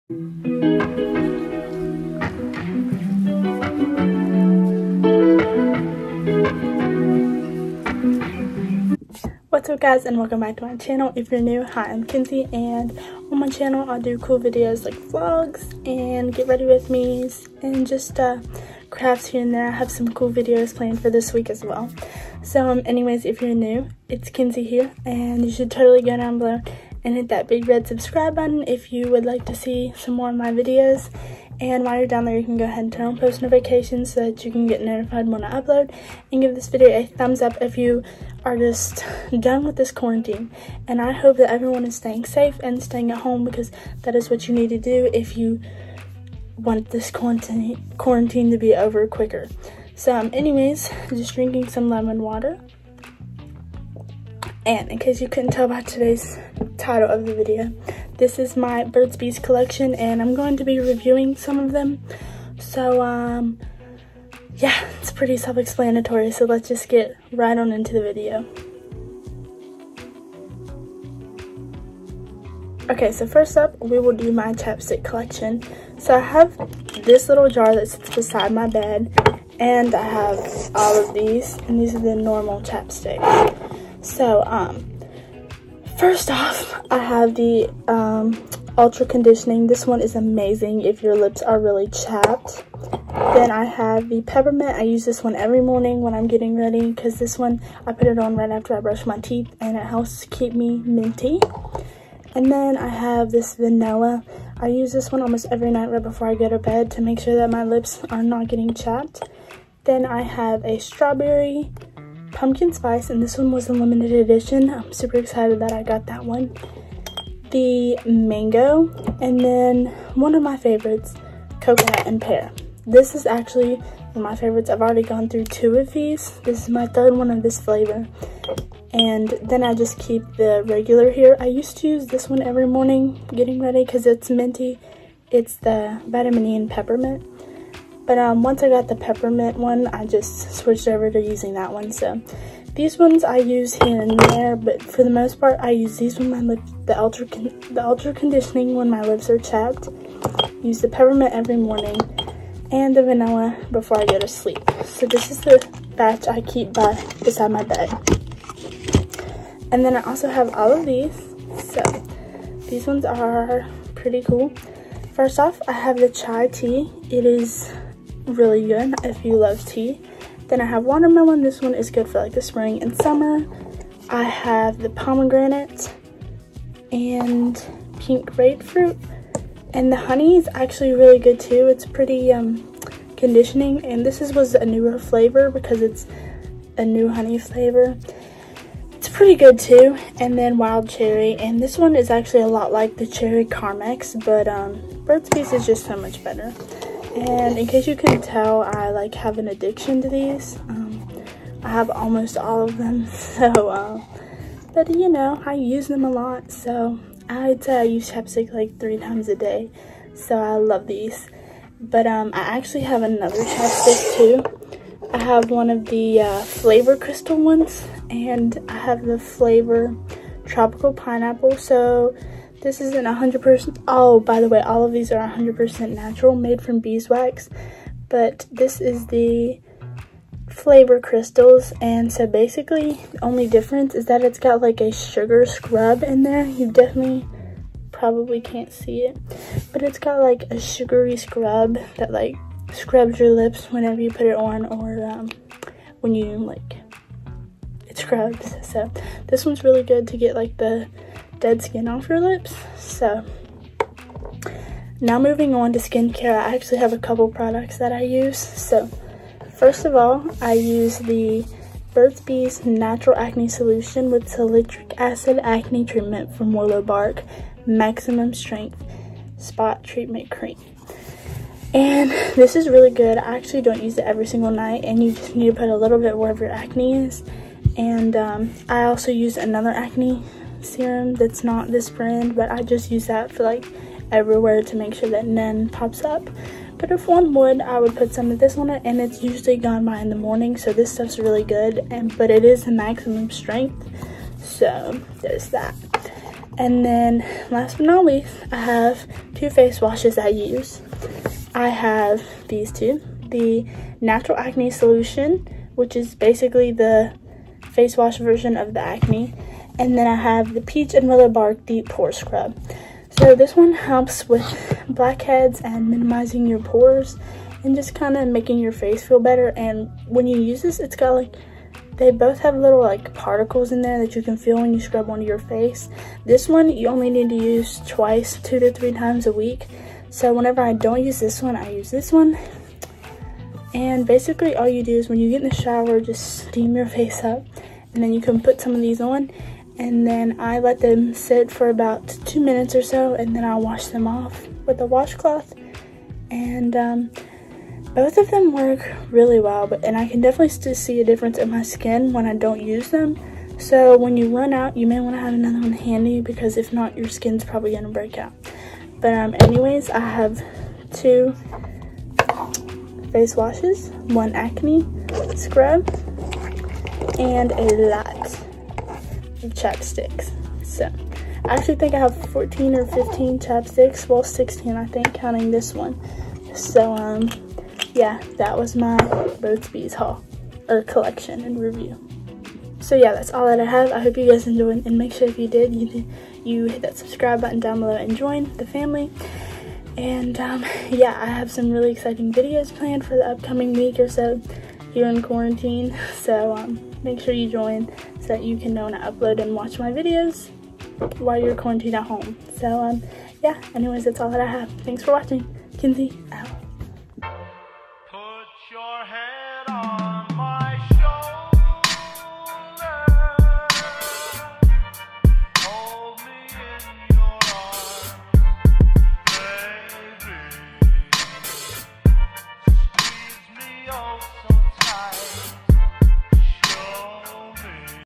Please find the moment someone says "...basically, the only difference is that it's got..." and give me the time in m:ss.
3:52.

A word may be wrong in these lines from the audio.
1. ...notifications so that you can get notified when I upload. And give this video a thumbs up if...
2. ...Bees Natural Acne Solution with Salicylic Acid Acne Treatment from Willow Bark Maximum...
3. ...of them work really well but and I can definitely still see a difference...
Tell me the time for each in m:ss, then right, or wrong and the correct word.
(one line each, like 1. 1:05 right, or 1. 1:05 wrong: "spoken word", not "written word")
1. 0:33 right
2. 4:22 right
3. 5:48 right.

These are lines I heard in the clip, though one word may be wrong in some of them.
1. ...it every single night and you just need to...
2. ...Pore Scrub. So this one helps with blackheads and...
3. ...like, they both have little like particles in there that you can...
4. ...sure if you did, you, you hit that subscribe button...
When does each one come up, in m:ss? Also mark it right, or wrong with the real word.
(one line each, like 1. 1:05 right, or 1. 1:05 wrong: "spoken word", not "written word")
1. 4:33 right
2. 5:11 right
3. 5:21 right
4. 6:25 right.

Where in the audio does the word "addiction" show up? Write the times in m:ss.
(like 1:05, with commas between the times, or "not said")
3:19.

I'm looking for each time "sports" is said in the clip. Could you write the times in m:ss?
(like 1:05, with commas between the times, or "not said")
not said.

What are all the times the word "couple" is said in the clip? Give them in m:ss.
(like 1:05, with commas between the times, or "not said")
4:16.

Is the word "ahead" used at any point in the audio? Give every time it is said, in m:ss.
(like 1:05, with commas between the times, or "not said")
0:32.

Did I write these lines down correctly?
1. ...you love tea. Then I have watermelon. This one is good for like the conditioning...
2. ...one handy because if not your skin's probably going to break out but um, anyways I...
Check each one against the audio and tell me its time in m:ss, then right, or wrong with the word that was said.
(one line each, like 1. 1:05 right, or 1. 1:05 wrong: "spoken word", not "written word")
1. 2:49 wrong: "spring", not "conditioning"
2. 5:55 right.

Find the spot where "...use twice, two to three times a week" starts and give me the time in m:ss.
5:27.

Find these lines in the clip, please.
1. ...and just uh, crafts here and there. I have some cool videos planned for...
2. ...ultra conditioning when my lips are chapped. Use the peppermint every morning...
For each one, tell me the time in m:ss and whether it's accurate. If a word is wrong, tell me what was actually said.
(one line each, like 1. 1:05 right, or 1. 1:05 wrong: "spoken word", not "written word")
1. 0:17 right
2. 2:27 right.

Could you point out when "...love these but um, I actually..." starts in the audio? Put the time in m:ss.
3:30.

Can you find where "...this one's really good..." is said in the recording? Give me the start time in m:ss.
4:09.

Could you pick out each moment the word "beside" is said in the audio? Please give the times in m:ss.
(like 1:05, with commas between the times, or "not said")
1:18, 2:37.